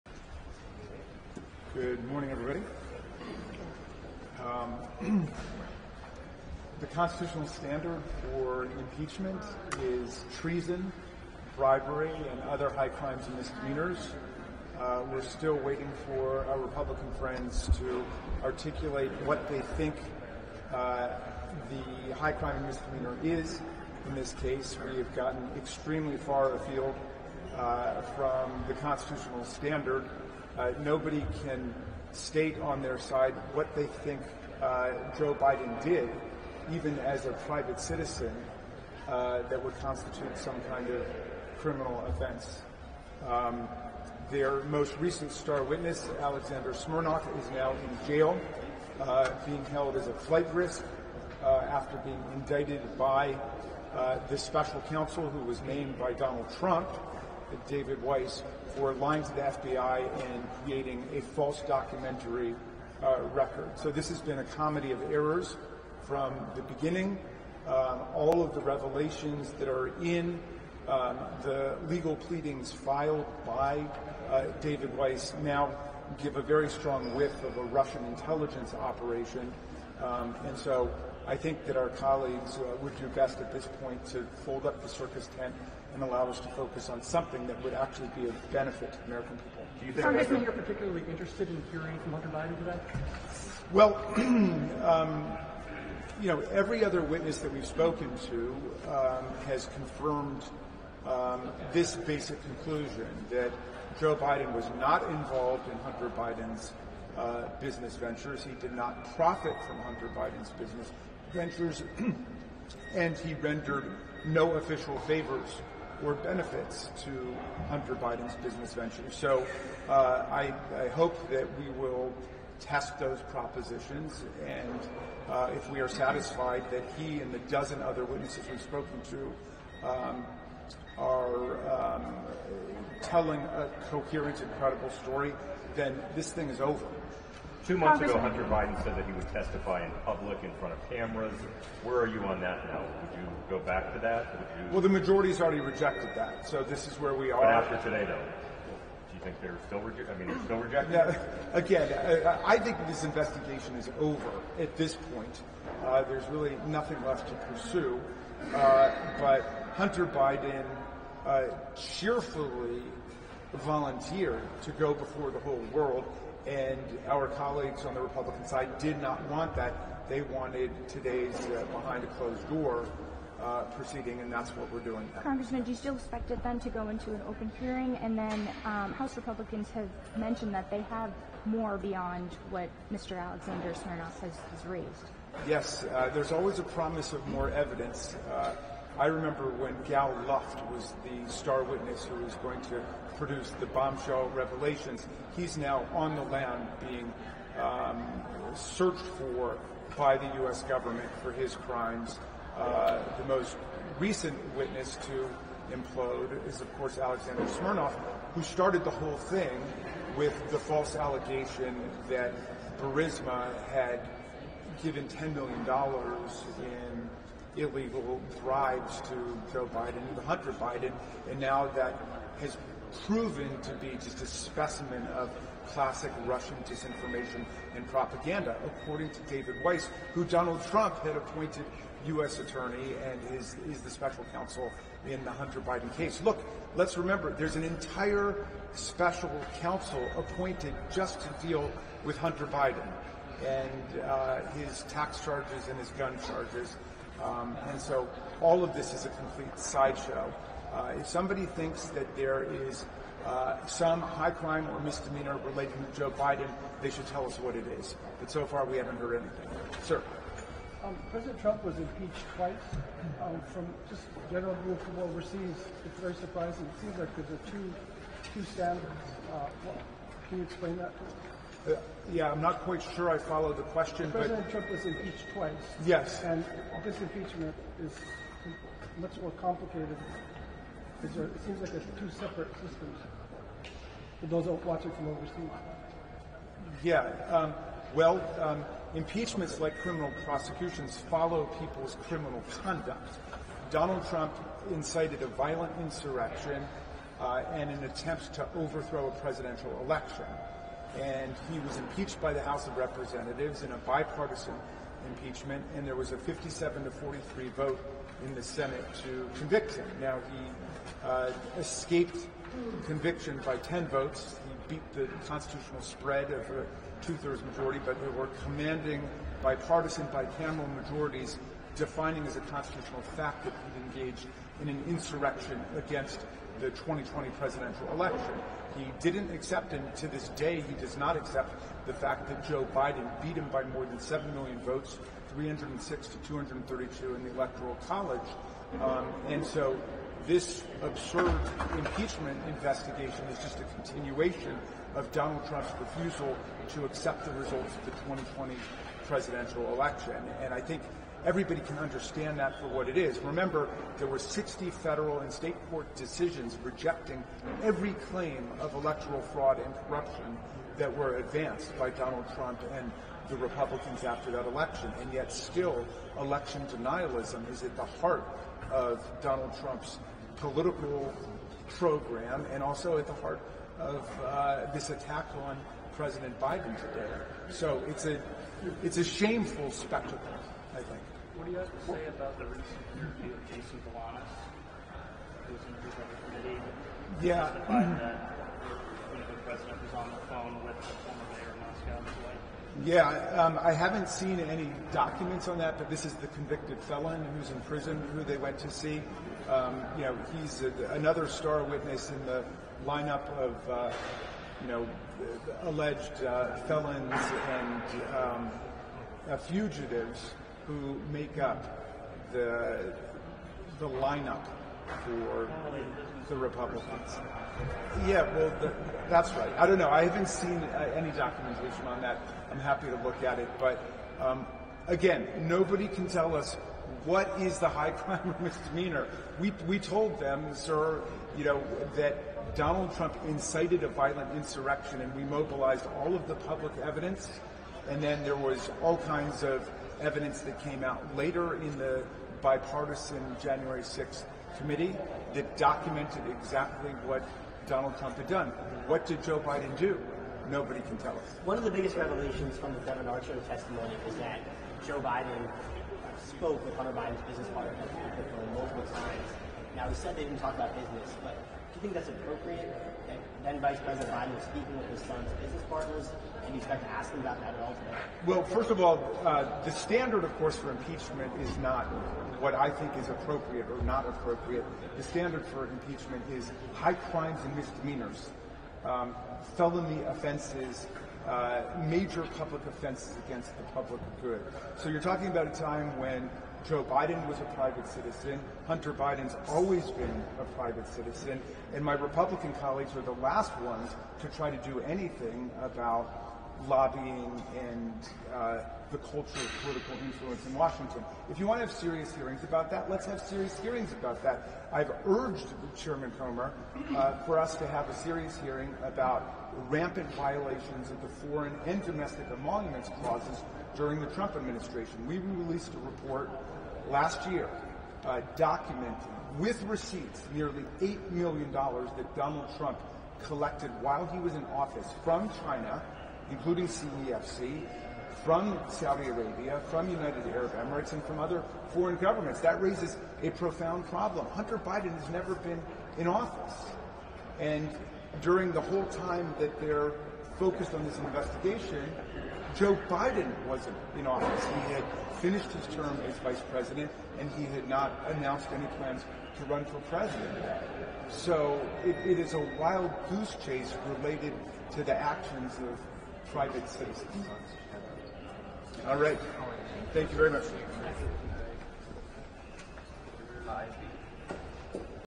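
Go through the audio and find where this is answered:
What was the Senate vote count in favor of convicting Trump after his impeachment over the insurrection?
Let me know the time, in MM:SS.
05:06.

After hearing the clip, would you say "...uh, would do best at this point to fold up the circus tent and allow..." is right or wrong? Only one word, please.
right.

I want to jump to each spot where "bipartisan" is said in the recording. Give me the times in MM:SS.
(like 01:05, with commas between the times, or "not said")
05:03, 05:19, 07:22.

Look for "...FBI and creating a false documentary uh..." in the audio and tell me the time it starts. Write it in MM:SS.
00:59.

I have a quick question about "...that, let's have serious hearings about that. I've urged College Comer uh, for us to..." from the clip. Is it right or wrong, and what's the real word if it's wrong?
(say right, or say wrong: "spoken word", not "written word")
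wrong: "Chairman", not "College".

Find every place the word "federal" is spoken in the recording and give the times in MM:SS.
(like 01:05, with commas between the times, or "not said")
05:54.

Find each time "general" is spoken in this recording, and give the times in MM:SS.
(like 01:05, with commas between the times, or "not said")
04:24.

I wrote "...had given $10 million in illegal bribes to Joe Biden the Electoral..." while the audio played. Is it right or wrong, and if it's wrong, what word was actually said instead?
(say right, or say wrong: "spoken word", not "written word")
wrong: "Hunter", not "Electoral".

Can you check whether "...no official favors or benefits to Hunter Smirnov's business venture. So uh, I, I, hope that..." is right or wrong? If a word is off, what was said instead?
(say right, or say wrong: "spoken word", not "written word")
wrong: "Biden", not "Smirnov".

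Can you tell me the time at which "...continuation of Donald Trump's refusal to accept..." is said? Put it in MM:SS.
05:43.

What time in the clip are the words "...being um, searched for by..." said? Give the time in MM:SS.
03:16.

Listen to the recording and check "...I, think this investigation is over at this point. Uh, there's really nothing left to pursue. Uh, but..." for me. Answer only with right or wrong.
right.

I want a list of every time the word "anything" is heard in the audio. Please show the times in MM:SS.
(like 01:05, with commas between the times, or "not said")
04:19, 08:14.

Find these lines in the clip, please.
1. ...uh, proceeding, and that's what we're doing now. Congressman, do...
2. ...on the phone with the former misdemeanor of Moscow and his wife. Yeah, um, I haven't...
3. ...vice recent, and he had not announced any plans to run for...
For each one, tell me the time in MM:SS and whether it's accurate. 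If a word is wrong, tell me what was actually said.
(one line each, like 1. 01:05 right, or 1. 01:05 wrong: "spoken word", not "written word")
1. 02:53 right
2. 06:29 wrong: "mayor", not "misdemeanor"
3. 09:06 wrong: "president", not "recent".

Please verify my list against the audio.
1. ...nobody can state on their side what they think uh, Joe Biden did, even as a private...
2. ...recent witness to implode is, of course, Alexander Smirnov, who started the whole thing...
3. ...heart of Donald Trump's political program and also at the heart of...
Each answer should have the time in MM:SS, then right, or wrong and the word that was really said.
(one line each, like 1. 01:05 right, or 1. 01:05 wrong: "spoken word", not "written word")
1. 00:30 right
2. 03:23 right
3. 06:07 right.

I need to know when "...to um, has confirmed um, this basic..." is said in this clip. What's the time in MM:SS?
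01:38.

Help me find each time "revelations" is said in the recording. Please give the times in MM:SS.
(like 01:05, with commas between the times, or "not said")
01:08, 03:14, 07:31.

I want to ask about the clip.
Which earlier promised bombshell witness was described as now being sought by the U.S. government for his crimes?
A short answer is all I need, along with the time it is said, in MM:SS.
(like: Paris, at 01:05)
Gal Luft, at 03:09.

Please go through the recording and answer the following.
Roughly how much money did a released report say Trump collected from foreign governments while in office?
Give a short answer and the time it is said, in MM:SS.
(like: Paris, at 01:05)
nearly $8 million, at 08:40.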